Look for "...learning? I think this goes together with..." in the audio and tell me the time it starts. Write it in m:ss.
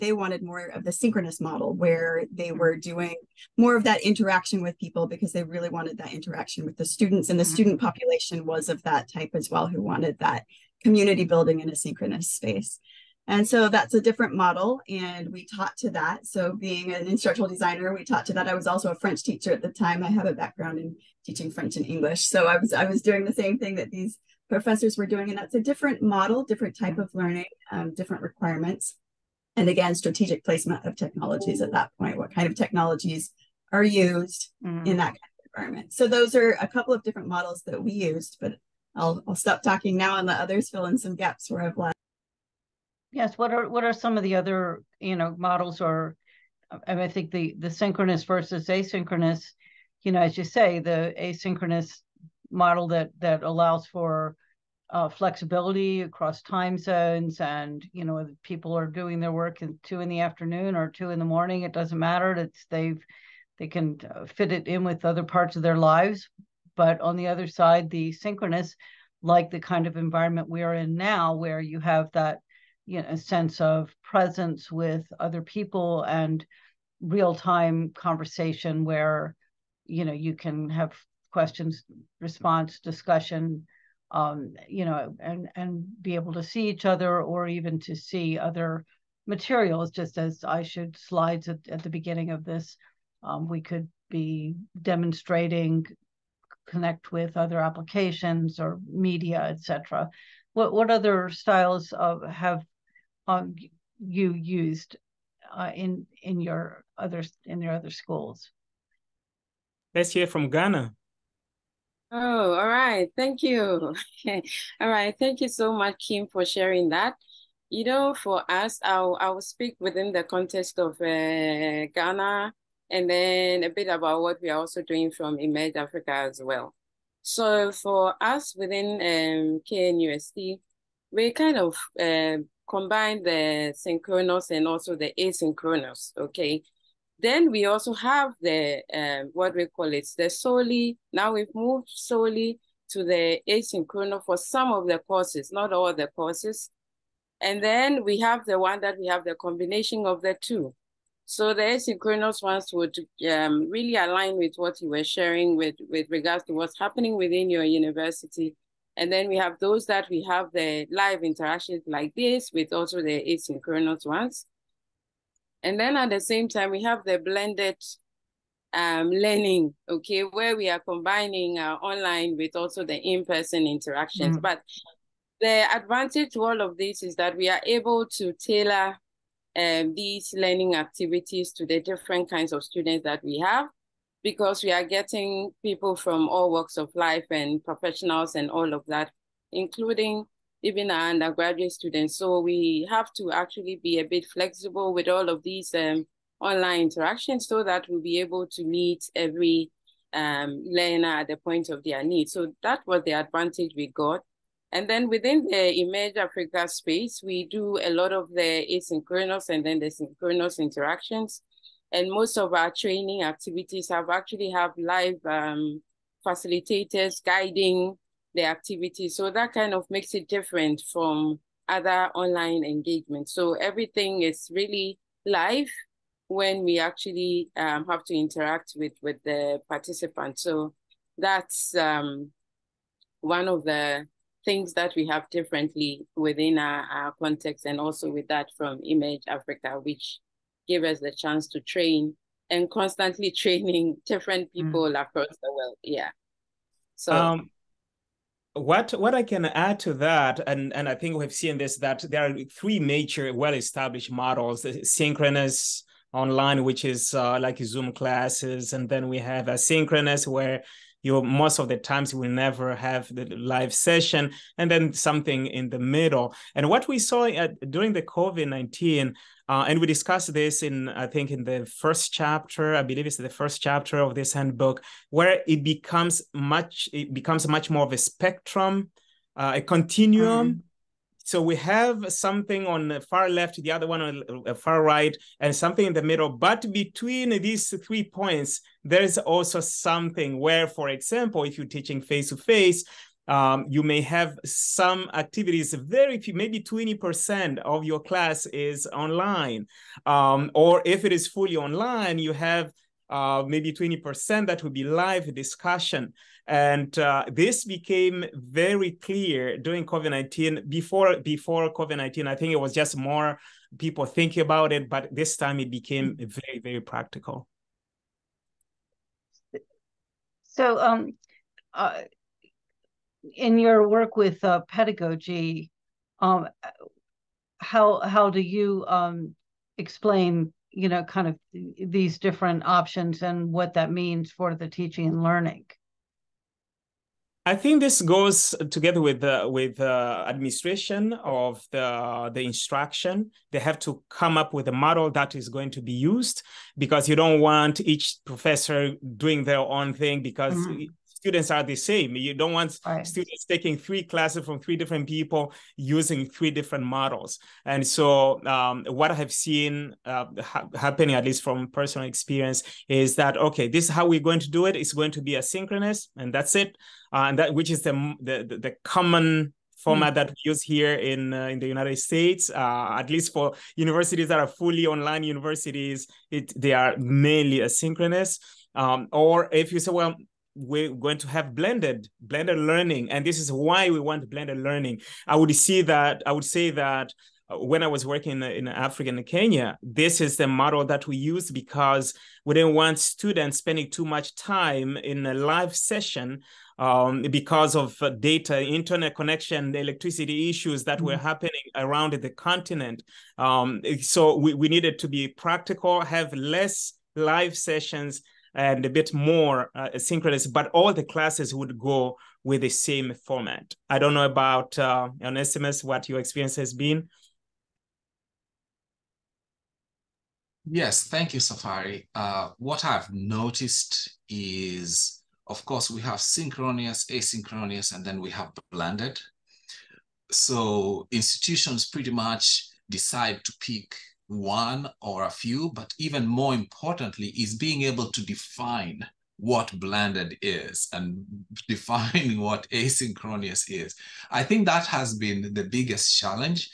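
5:35.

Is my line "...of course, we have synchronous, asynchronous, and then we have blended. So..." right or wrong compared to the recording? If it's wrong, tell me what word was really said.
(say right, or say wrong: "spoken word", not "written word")
right.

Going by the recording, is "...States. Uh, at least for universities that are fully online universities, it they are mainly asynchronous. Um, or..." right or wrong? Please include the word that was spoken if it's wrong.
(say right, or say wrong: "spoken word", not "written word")
right.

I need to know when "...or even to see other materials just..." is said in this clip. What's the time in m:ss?
1:27.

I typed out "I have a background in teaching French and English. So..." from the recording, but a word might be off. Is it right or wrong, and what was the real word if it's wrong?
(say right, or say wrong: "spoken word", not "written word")
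right.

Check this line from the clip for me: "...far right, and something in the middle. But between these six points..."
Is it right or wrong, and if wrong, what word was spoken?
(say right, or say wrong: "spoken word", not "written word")
wrong: "three", not "six".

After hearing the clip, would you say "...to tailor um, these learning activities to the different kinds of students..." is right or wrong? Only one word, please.
right.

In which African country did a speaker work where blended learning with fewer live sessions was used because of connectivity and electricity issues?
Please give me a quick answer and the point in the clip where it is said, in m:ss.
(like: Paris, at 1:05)
Kenya, at 6:29.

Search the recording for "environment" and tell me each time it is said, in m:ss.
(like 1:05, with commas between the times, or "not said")
0:35, 1:09.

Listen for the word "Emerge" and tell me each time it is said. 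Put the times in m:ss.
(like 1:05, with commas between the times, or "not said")
2:05, 3:25, 3:58.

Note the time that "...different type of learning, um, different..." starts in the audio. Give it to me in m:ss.
0:26.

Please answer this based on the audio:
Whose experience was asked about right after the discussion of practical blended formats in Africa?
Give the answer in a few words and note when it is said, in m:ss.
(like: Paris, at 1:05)
Onesimus, at 6:55.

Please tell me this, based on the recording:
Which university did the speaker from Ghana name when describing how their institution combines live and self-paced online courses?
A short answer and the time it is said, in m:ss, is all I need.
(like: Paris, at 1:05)
KNUST, at 2:09.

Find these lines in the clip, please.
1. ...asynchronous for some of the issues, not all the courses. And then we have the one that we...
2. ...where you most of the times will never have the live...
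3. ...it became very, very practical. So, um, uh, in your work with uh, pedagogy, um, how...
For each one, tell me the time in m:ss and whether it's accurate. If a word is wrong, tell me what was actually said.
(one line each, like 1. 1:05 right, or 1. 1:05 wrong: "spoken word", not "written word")
1. 2:23 wrong: "courses", not "issues"
2. 4:20 right
3. 5:15 right.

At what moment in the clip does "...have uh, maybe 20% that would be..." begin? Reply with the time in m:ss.
5:02.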